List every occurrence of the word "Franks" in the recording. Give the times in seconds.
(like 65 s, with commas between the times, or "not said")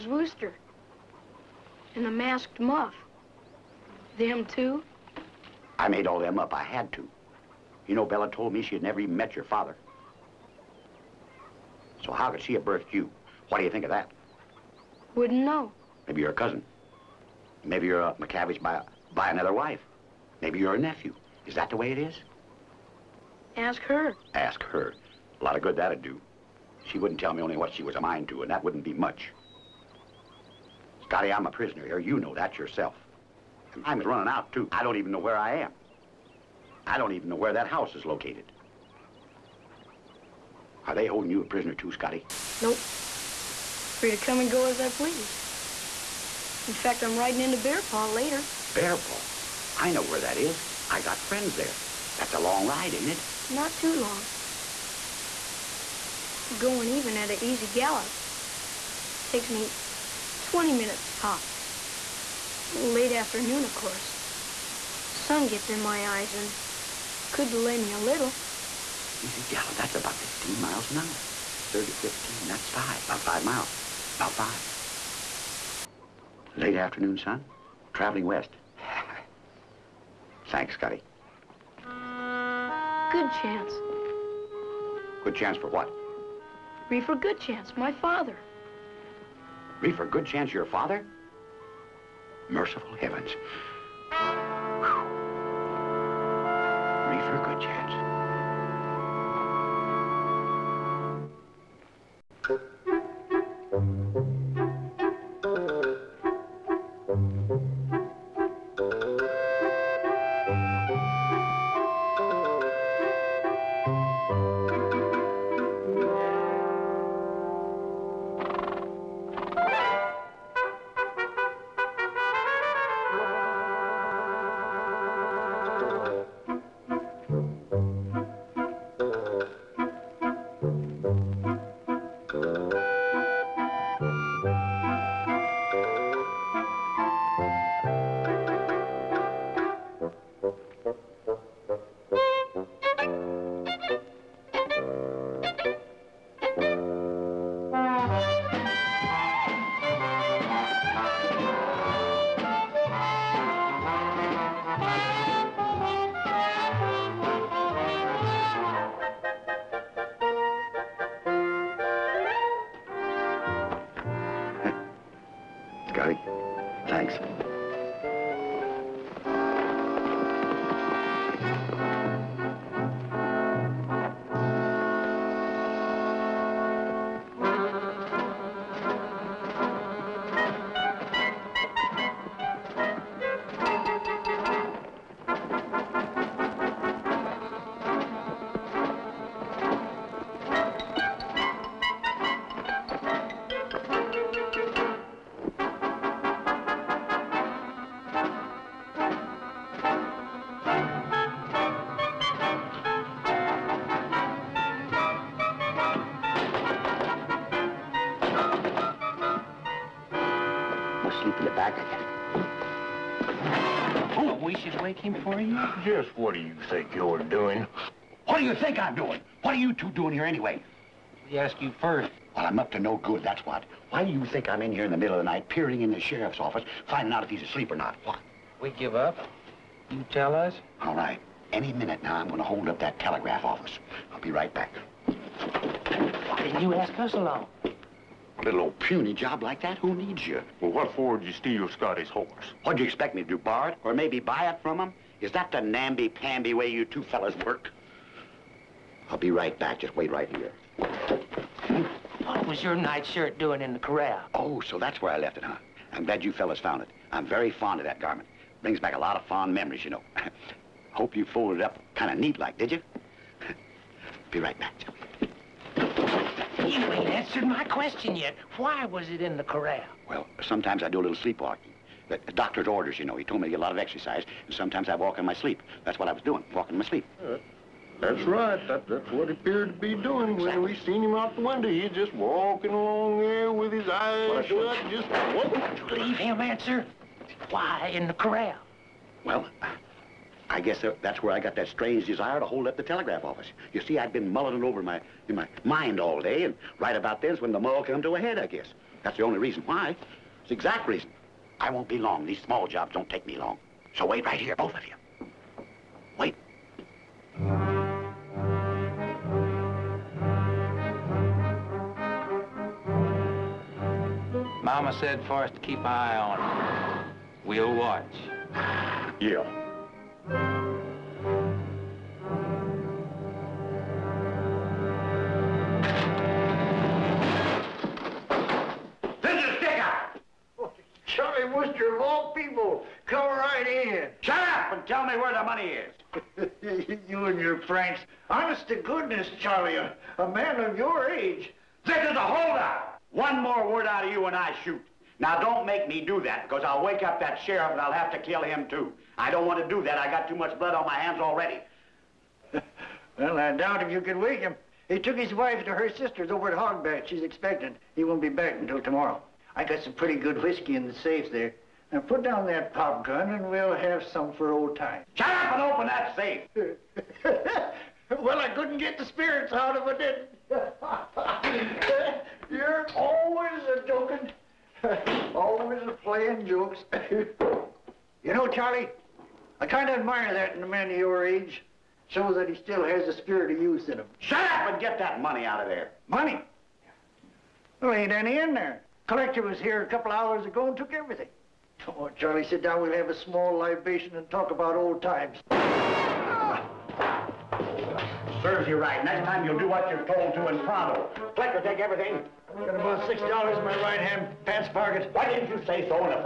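337 s.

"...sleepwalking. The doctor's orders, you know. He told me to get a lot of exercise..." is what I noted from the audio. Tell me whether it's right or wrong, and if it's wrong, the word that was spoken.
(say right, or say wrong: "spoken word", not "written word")
right.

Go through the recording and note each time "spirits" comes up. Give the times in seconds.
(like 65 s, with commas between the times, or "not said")
369 s, 383 s.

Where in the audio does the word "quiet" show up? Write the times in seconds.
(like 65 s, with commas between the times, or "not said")
not said.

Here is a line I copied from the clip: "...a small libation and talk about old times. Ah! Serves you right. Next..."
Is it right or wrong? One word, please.
right.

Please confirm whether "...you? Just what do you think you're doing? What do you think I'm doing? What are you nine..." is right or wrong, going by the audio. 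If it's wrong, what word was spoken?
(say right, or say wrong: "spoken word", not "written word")
wrong: "two", not "nine".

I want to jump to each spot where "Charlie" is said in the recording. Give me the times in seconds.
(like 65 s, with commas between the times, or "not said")
339 s, 378 s, 392 s.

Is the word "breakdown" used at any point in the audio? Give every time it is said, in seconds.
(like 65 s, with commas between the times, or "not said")
not said.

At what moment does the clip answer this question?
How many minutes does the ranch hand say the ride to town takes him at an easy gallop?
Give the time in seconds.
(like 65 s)
60 s.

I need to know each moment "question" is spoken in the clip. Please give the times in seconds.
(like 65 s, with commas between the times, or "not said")
267 s.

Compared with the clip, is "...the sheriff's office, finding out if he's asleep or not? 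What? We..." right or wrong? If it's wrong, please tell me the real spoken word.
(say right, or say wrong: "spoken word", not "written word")
right.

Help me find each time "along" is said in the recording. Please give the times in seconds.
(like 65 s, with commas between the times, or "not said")
237 s, 282 s.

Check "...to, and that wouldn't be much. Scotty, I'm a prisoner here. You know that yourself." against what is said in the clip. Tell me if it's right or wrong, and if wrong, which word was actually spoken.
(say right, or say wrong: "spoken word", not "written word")
right.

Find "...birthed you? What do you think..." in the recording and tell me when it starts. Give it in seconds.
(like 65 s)
12 s.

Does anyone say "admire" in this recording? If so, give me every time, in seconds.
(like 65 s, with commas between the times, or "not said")
379 s.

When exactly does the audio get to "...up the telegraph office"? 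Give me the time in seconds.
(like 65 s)
292 s.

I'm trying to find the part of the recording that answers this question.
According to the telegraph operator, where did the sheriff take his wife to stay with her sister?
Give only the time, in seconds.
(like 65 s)
356 s.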